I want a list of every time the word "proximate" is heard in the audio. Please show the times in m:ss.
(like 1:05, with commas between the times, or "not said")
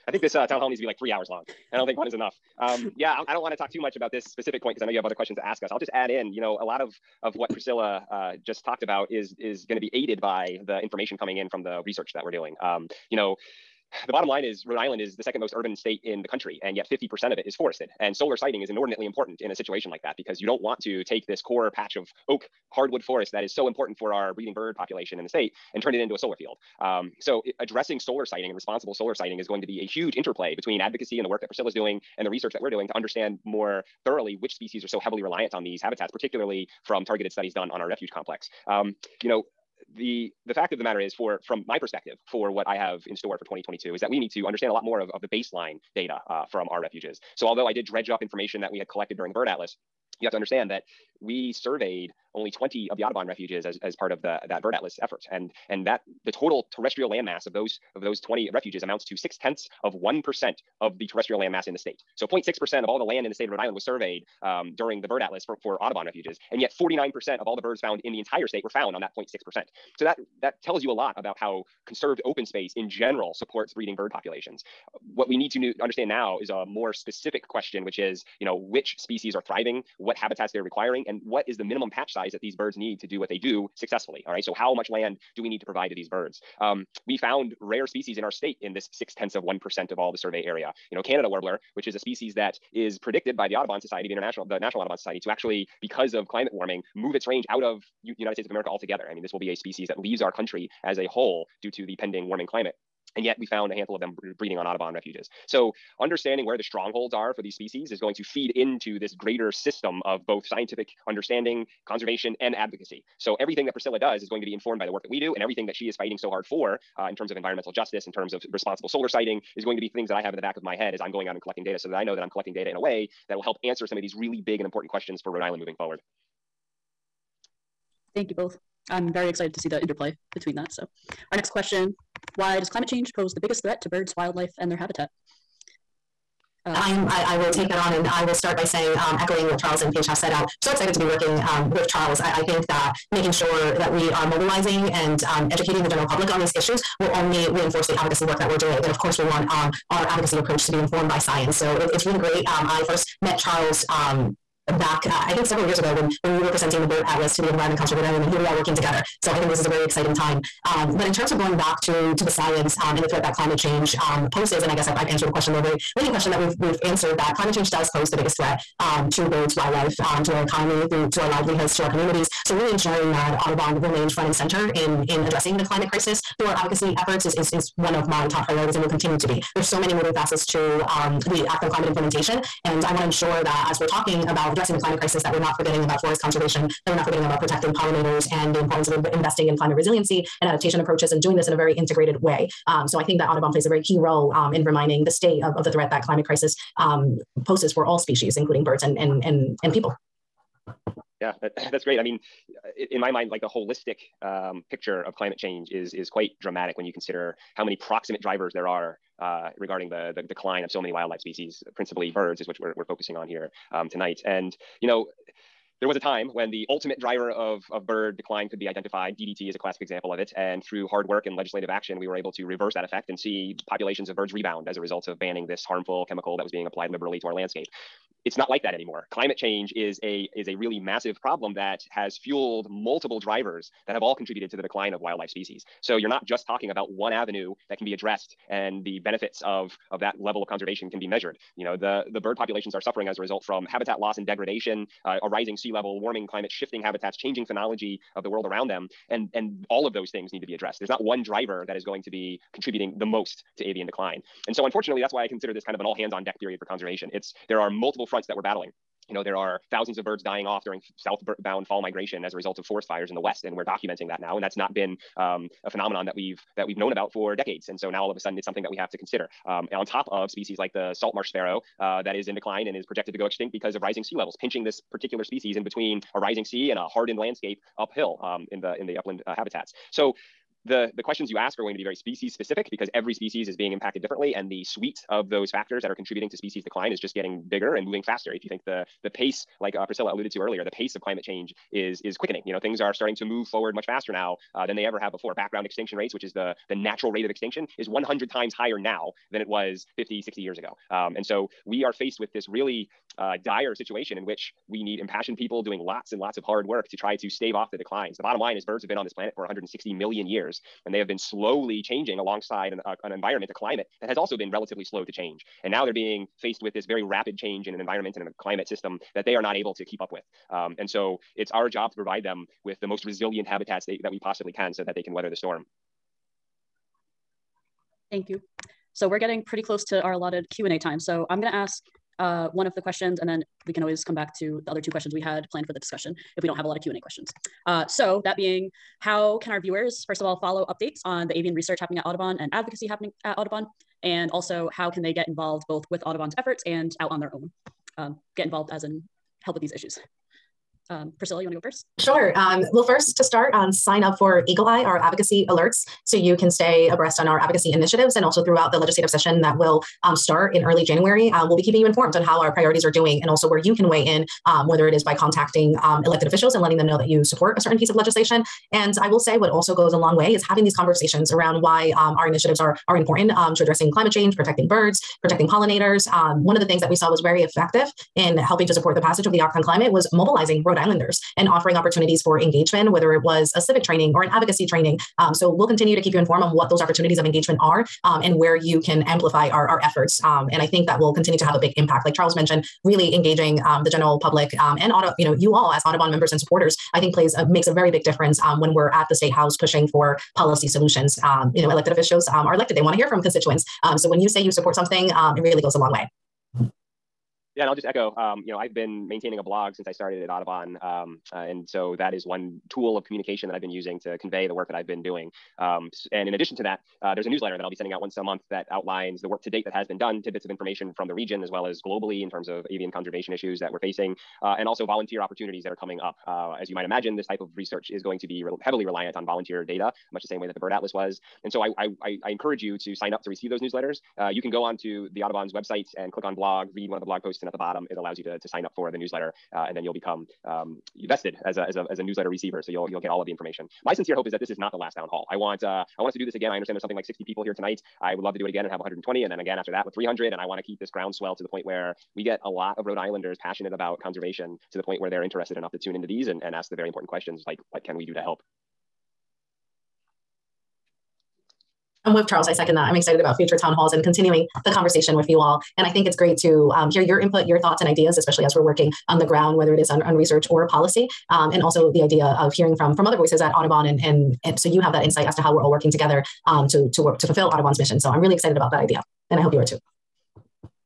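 3:27.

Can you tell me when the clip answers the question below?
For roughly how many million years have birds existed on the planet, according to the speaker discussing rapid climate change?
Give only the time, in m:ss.
5:09.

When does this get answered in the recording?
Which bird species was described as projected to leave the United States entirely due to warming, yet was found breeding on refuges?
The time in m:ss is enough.
1:31.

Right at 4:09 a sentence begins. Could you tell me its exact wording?
And, and all of those things need to be addressed.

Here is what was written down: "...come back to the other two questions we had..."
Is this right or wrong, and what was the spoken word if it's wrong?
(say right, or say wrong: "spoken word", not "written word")
right.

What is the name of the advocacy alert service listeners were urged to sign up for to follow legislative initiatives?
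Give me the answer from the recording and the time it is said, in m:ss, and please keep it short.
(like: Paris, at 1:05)
Eagle Eye, at 5:54.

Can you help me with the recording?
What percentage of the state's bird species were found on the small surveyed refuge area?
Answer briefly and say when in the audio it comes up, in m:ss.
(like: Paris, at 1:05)
49%, at 1:06.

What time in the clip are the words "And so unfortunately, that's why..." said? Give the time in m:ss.
4:14.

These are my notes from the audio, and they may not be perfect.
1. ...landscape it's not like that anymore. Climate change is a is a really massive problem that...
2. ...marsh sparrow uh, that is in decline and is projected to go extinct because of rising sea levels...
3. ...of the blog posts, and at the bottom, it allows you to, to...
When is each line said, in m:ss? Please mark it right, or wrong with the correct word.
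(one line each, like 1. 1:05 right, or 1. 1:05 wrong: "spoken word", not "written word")
1. 3:47 right
2. 4:31 right
3. 7:16 right.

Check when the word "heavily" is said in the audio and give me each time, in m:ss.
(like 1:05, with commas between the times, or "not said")
0:34, 7:08.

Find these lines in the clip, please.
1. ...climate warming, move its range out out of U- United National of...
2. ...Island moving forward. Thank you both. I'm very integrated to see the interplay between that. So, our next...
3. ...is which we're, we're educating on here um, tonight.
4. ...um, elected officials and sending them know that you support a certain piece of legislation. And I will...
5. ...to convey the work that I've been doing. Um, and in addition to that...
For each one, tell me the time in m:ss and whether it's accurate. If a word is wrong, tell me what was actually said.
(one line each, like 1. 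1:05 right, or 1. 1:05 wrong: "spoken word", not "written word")
1. 1:36 wrong: "States", not "National"
2. 2:05 wrong: "excited", not "integrated"
3. 3:32 wrong: "focusing", not "educating"
4. 6:05 wrong: "letting", not "sending"
5. 6:54 right.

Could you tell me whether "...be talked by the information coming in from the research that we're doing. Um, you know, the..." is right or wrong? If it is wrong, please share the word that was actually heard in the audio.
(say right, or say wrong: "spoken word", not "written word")
wrong: "aided", not "talked".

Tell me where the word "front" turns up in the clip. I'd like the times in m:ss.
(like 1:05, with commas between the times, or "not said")
2:54, 4:18.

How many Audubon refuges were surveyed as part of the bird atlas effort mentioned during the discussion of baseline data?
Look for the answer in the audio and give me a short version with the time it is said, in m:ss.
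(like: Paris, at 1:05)
20, at 0:52.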